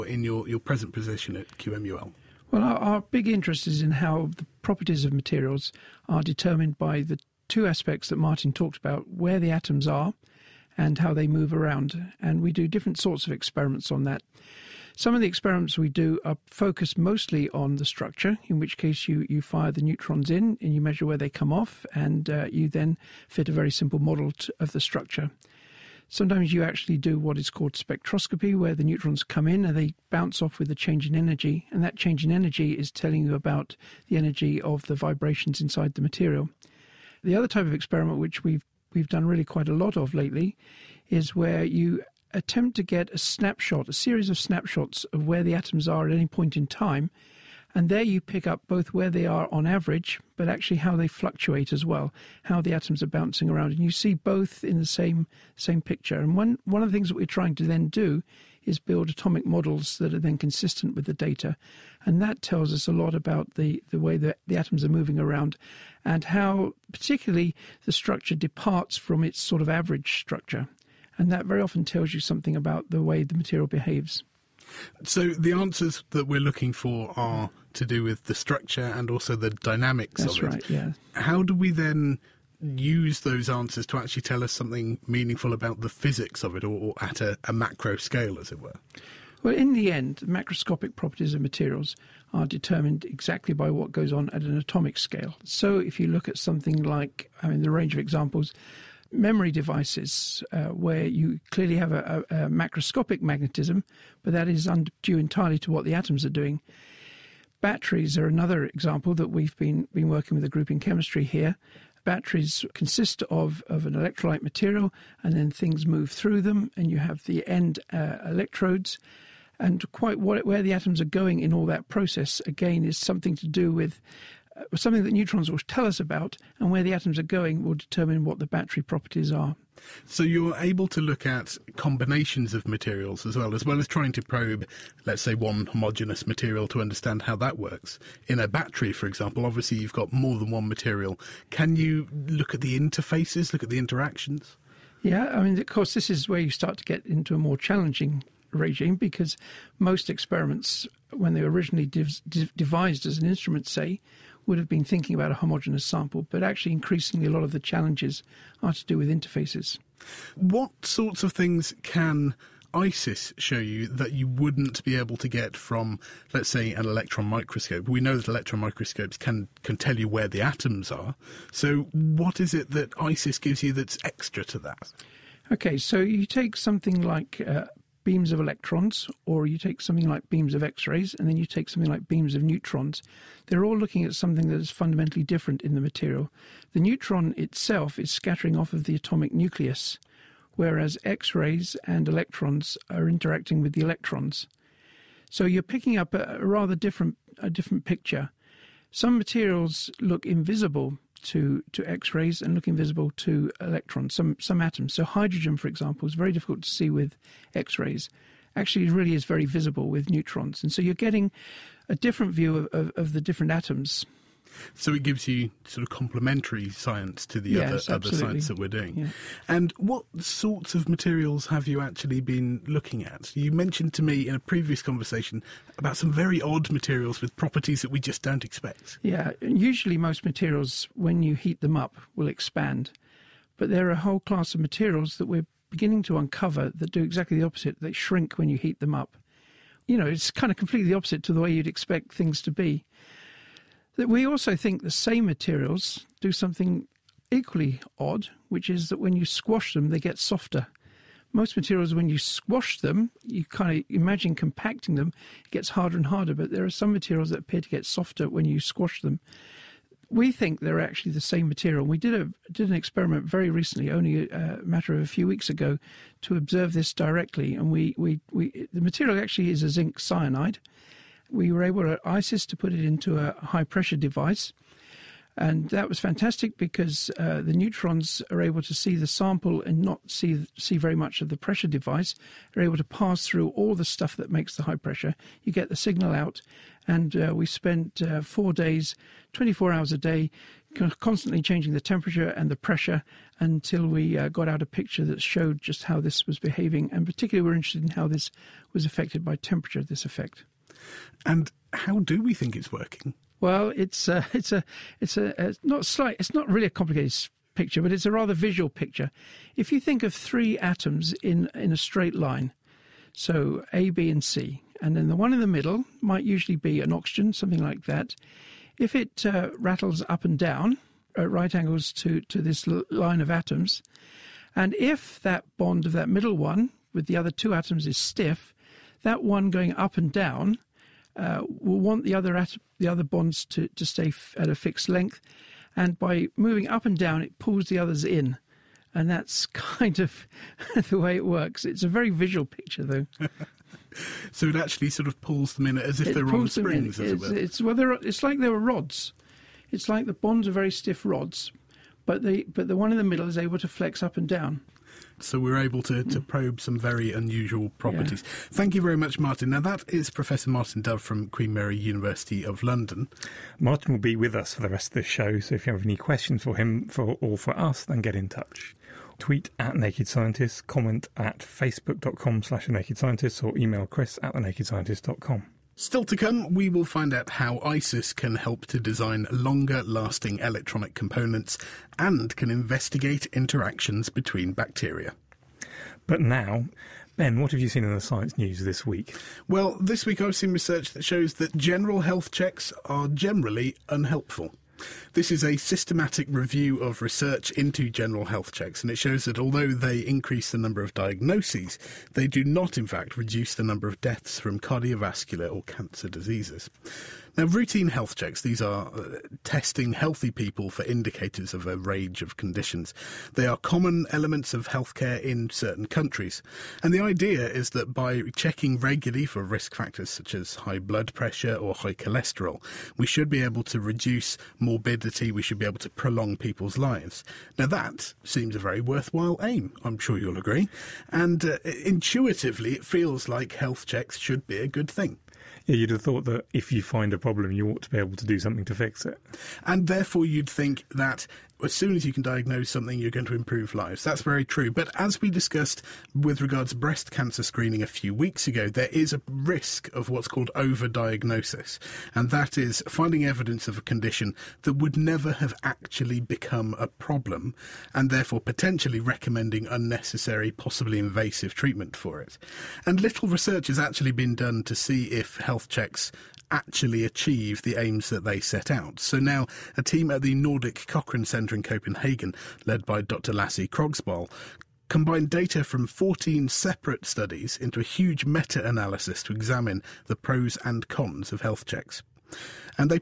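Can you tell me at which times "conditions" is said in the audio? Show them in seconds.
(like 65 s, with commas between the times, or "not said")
412 s, 453 s.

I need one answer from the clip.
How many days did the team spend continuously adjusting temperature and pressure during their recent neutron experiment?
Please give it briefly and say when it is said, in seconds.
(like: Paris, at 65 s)
4, at 288 s.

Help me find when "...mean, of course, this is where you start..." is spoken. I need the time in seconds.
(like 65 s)
145 s.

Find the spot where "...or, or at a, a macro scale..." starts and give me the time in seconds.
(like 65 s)
86 s.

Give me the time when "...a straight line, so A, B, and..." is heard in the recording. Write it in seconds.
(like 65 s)
311 s.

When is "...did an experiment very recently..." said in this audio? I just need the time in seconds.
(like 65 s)
262 s.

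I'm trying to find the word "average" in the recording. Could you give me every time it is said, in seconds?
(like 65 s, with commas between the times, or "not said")
49 s, 69 s.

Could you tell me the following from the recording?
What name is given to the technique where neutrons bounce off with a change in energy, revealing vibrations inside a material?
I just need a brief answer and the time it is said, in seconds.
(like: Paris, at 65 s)
spectroscopy, at 27 s.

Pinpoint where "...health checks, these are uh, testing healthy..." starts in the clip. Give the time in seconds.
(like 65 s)
407 s.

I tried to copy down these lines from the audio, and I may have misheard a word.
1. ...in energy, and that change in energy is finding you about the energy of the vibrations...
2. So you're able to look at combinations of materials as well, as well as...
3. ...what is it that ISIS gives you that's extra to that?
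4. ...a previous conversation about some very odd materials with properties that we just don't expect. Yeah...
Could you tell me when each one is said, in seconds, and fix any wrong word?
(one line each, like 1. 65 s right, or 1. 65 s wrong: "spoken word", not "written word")
1. 31 s wrong: "telling", not "finding"
2. 130 s right
3. 171 s right
4. 224 s right.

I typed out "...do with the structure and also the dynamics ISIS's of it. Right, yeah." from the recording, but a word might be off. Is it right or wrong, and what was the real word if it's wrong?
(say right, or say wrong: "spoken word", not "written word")
wrong: "That", not "ISIS".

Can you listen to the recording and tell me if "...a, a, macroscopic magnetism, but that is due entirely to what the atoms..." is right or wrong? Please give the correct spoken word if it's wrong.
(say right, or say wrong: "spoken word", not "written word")
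right.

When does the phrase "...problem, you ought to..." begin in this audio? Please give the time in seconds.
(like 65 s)
437 s.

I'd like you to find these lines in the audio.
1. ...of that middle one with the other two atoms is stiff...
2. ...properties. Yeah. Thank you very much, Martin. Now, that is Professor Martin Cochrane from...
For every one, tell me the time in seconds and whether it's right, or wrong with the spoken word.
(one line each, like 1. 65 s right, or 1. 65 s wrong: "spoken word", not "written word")
1. 325 s right
2. 357 s wrong: "Dove", not "Cochrane".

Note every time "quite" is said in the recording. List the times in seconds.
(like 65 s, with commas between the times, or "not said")
39 s, 119 s.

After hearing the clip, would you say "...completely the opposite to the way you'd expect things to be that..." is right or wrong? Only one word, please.
right.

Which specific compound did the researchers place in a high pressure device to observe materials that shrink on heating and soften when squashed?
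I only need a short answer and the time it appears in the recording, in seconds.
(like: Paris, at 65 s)
zinc cyanide, at 269 s.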